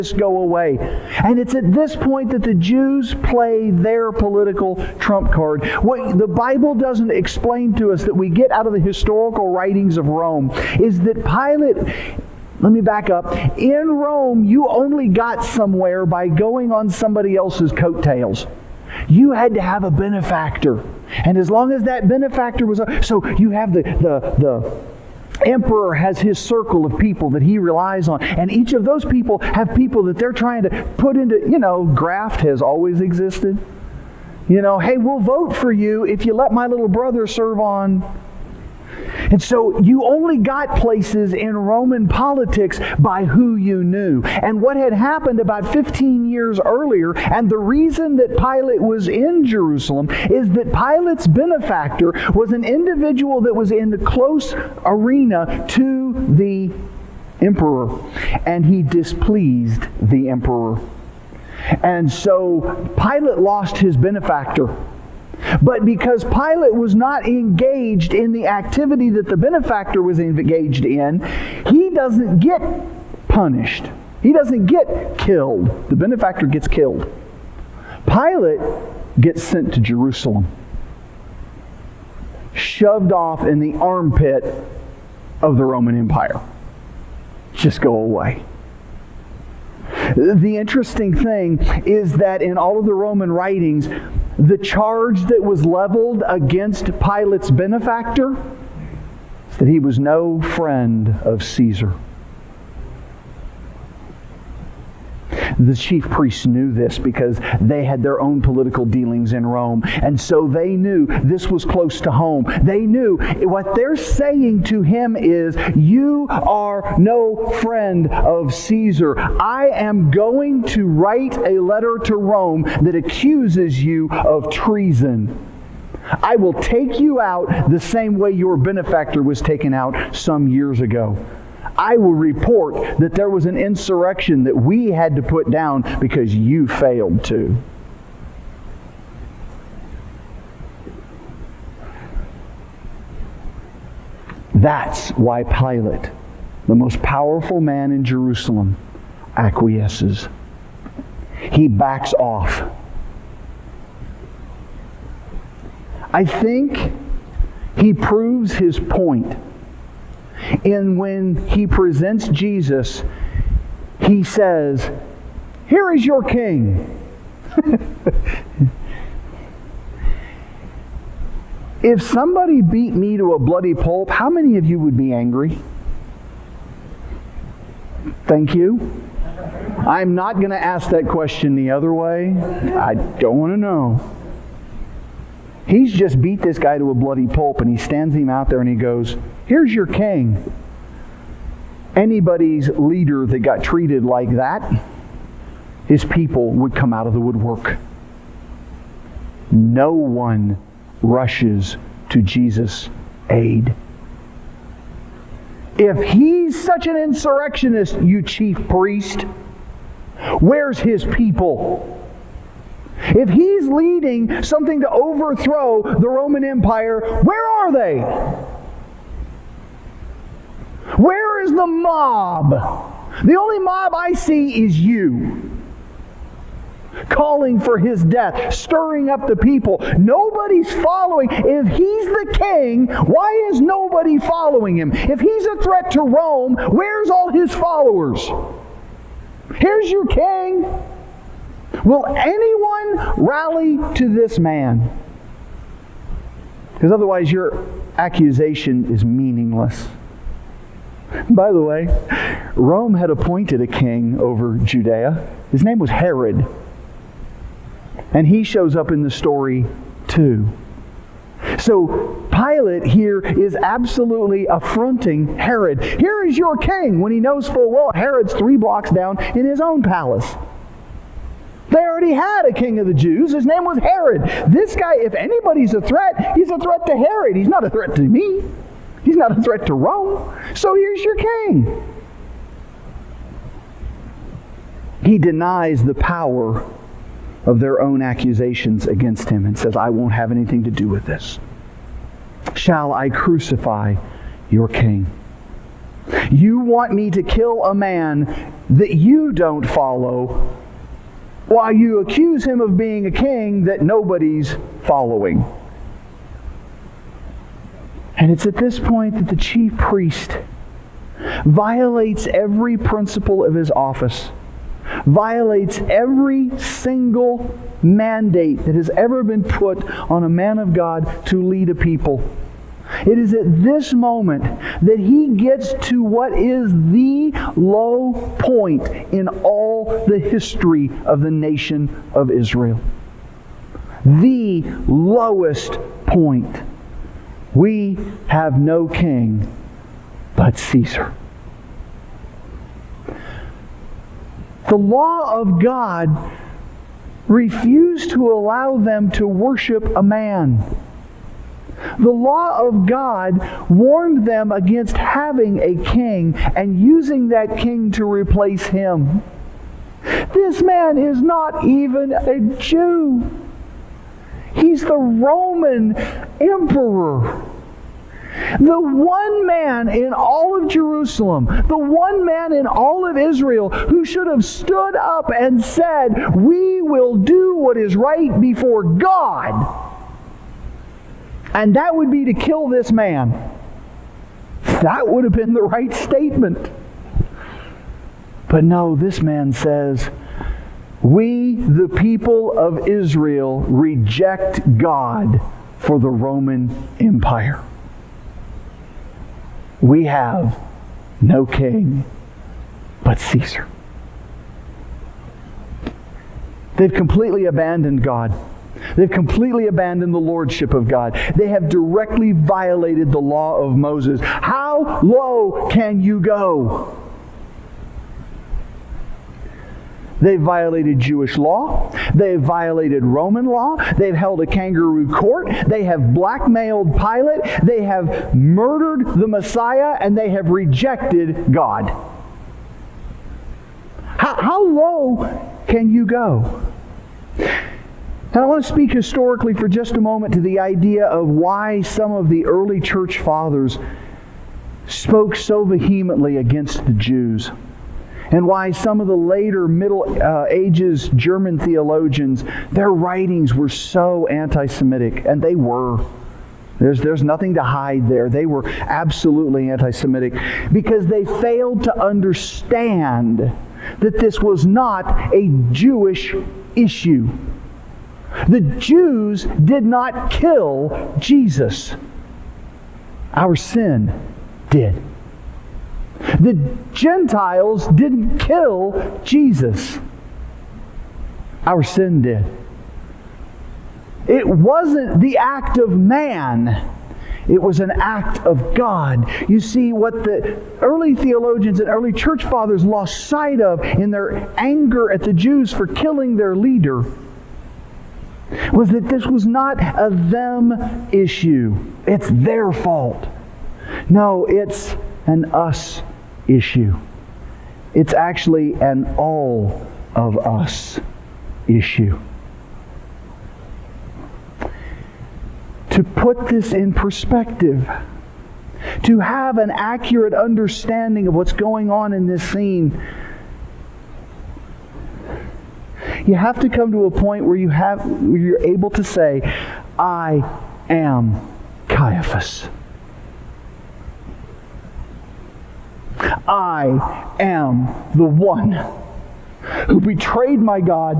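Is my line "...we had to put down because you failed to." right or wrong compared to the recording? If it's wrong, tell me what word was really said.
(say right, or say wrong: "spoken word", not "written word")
right.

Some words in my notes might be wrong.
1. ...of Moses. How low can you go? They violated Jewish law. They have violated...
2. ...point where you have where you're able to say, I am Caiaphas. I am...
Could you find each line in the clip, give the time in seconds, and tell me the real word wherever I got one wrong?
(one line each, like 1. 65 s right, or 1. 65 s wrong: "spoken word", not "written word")
1. 413 s right
2. 527 s right.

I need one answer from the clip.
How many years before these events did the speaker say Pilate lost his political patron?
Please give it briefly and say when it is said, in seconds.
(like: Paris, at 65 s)
15 years, at 45 s.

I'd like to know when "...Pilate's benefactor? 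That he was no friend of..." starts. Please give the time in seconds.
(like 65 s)
96 s.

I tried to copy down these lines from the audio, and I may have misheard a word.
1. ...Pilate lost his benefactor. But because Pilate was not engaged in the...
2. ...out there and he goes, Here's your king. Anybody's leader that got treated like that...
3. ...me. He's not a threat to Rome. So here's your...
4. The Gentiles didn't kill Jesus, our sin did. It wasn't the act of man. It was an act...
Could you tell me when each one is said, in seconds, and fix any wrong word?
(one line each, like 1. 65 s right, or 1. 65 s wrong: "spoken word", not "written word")
1. 62 s right
2. 188 s right
3. 278 s right
4. 476 s right.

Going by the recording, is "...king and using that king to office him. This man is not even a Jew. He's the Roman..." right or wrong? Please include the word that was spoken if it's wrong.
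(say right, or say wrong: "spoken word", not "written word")
wrong: "replace", not "office".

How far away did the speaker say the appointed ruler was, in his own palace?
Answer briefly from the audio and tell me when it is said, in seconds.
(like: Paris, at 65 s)
three blocks, at 268 s.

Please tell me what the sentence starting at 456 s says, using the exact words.
There's, there's nothing to hide there.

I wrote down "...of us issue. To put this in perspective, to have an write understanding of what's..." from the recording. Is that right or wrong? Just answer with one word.
wrong.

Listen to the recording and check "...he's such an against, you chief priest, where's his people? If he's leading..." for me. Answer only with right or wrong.
wrong.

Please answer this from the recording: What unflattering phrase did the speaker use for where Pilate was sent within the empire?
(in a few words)
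the armpit of the Roman Empire.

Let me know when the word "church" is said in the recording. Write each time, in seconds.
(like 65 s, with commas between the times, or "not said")
442 s, 492 s.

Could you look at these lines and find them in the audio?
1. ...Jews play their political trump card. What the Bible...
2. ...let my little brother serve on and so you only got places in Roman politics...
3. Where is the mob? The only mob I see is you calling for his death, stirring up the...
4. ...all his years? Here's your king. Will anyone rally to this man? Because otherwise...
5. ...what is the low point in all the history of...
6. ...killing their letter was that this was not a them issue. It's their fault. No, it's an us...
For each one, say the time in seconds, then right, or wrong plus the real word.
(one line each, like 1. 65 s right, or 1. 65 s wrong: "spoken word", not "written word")
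1. 2 s right
2. 36 s right
3. 221 s right
4. 237 s wrong: "followers", not "years"
5. 326 s right
6. 495 s wrong: "leader", not "letter".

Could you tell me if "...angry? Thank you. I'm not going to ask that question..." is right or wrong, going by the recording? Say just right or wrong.
right.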